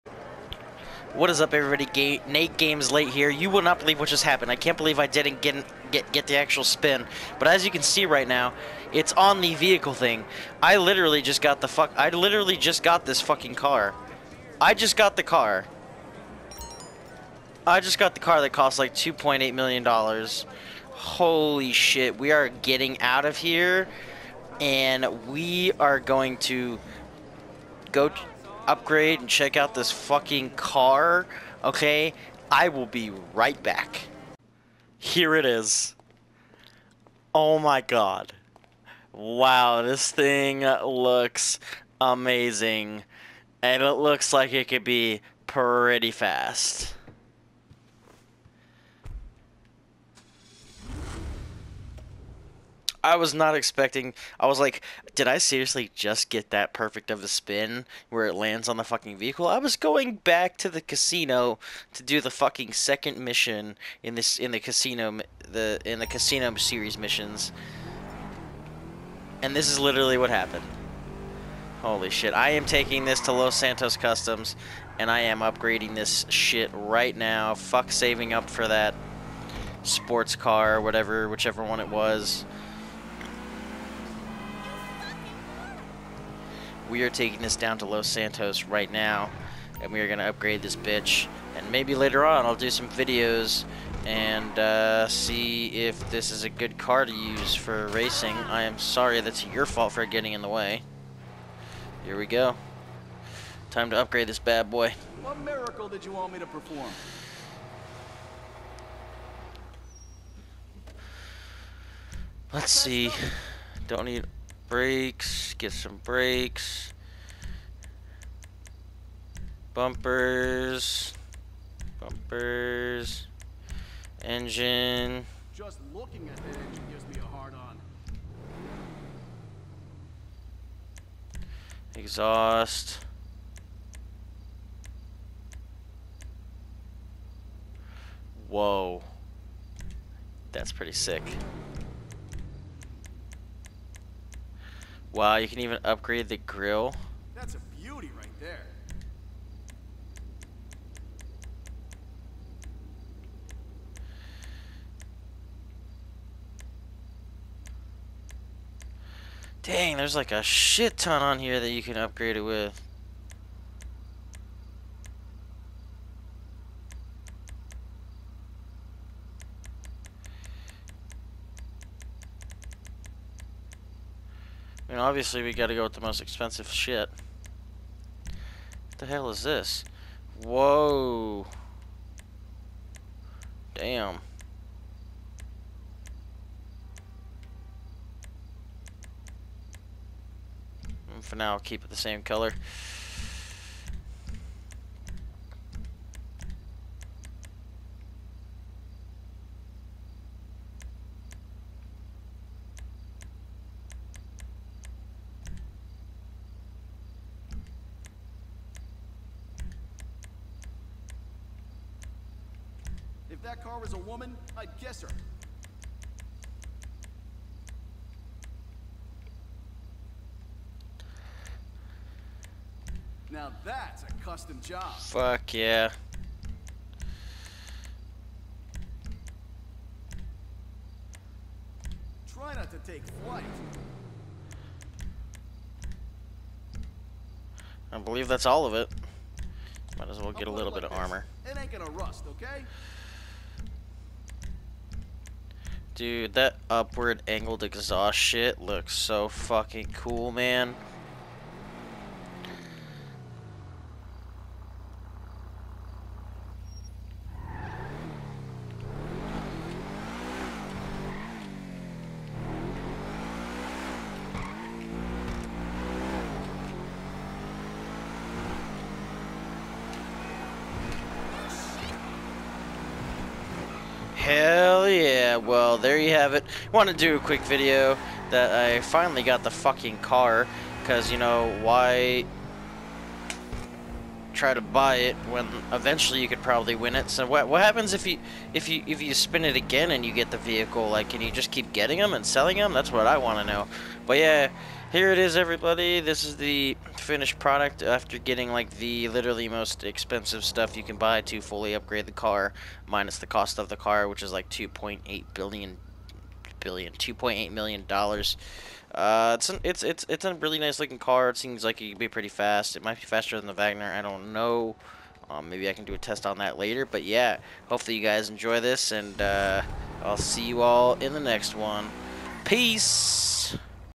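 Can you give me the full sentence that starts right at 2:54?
mean, obviously we gotta go with the most expensive shit.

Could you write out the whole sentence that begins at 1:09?
And this is literally what happened.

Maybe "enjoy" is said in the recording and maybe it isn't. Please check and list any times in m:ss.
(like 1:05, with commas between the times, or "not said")
5:18.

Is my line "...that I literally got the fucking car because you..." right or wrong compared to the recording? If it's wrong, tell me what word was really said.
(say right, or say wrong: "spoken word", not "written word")
wrong: "finally", not "literally".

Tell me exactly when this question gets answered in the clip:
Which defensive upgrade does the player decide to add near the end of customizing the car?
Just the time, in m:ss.
4:00.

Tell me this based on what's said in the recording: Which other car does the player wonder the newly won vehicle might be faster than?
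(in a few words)
the Vagner.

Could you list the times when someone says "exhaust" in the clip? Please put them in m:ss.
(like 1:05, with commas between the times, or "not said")
2:11, 4:07.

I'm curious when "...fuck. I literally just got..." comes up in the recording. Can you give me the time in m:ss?
0:11.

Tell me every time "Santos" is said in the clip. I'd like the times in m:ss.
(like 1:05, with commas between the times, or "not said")
1:13, 1:28.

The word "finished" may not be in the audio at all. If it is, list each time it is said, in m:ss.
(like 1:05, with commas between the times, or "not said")
4:56.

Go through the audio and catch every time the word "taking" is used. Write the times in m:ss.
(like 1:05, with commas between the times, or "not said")
1:12, 1:27.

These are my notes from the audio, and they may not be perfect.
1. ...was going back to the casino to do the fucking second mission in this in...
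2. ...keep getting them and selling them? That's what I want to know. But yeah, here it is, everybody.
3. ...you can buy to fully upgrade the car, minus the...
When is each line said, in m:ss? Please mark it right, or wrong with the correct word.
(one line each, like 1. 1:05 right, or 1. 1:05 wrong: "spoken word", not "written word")
1. 0:59 right
2. 4:51 right
3. 5:00 right.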